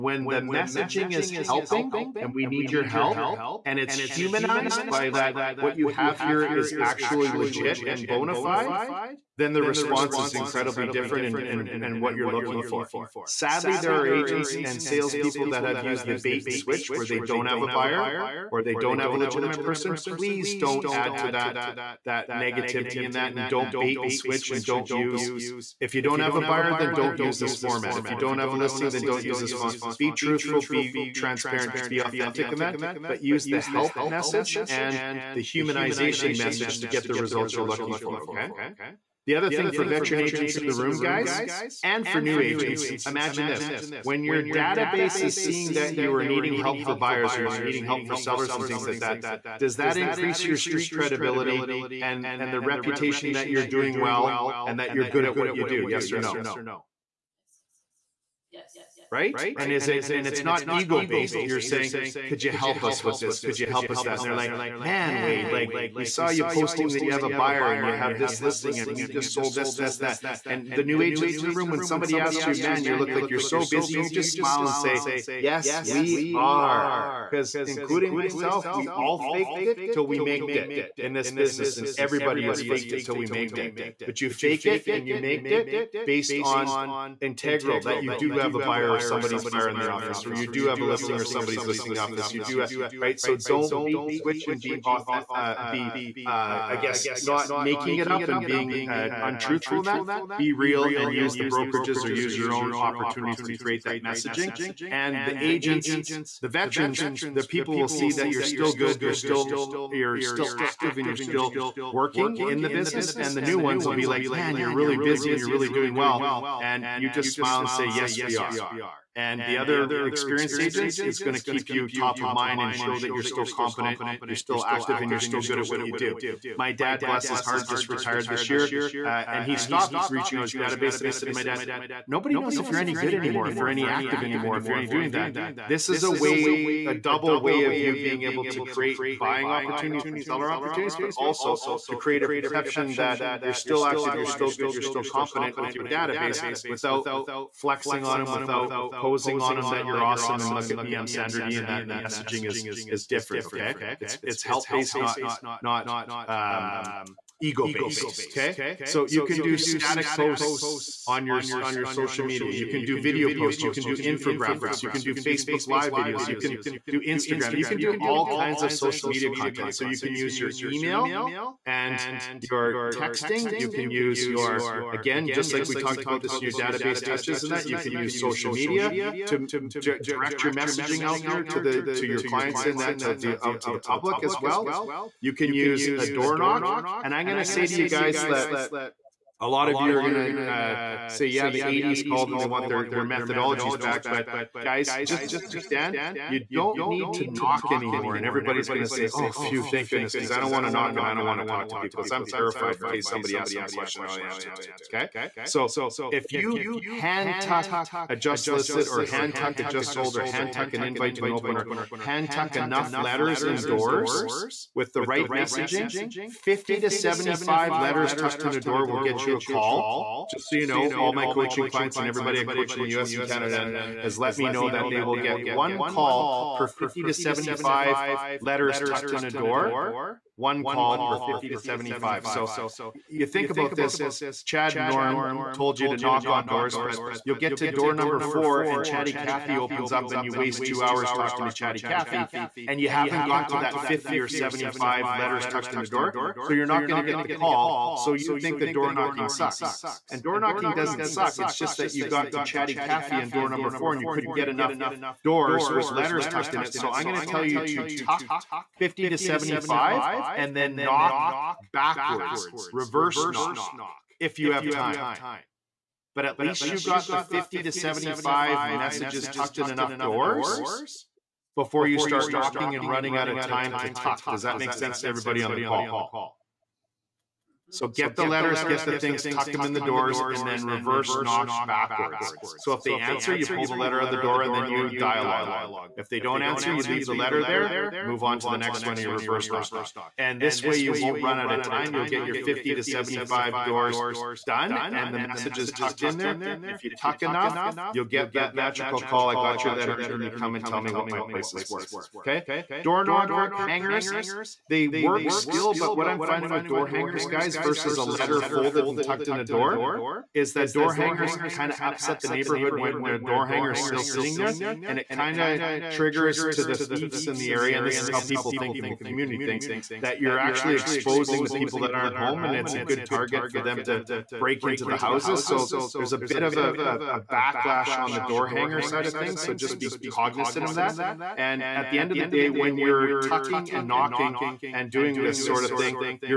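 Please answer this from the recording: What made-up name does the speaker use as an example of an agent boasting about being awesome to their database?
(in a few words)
Sandra Dee.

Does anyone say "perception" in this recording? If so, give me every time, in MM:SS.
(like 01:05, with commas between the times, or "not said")
02:22.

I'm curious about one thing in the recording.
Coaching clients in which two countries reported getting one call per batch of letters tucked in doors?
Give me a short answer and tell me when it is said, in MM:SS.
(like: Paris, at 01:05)
US and Canada, at 03:42.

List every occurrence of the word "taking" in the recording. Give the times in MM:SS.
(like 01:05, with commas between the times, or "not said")
not said.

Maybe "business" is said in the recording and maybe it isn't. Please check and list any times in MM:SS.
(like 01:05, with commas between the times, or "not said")
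01:21, 01:52.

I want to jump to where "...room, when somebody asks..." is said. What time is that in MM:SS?
01:11.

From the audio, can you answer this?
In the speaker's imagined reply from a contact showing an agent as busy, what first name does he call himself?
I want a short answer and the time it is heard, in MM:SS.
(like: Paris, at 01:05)
Wade, at 01:05.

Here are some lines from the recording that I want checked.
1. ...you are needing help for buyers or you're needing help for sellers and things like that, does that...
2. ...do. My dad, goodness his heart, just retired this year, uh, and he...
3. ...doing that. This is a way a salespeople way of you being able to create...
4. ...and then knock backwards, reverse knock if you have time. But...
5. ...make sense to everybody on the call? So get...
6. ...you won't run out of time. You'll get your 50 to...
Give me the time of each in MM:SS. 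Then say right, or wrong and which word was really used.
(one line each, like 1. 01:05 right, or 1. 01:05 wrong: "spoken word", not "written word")
1. 00:45 right
2. 02:05 wrong: "bless", not "goodness"
3. 02:14 wrong: "double", not "salespeople"
4. 04:20 right
5. 04:34 right
6. 04:50 right.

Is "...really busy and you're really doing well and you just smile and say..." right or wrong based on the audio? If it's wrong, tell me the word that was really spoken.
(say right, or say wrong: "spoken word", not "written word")
right.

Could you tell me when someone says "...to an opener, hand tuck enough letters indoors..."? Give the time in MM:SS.
03:31.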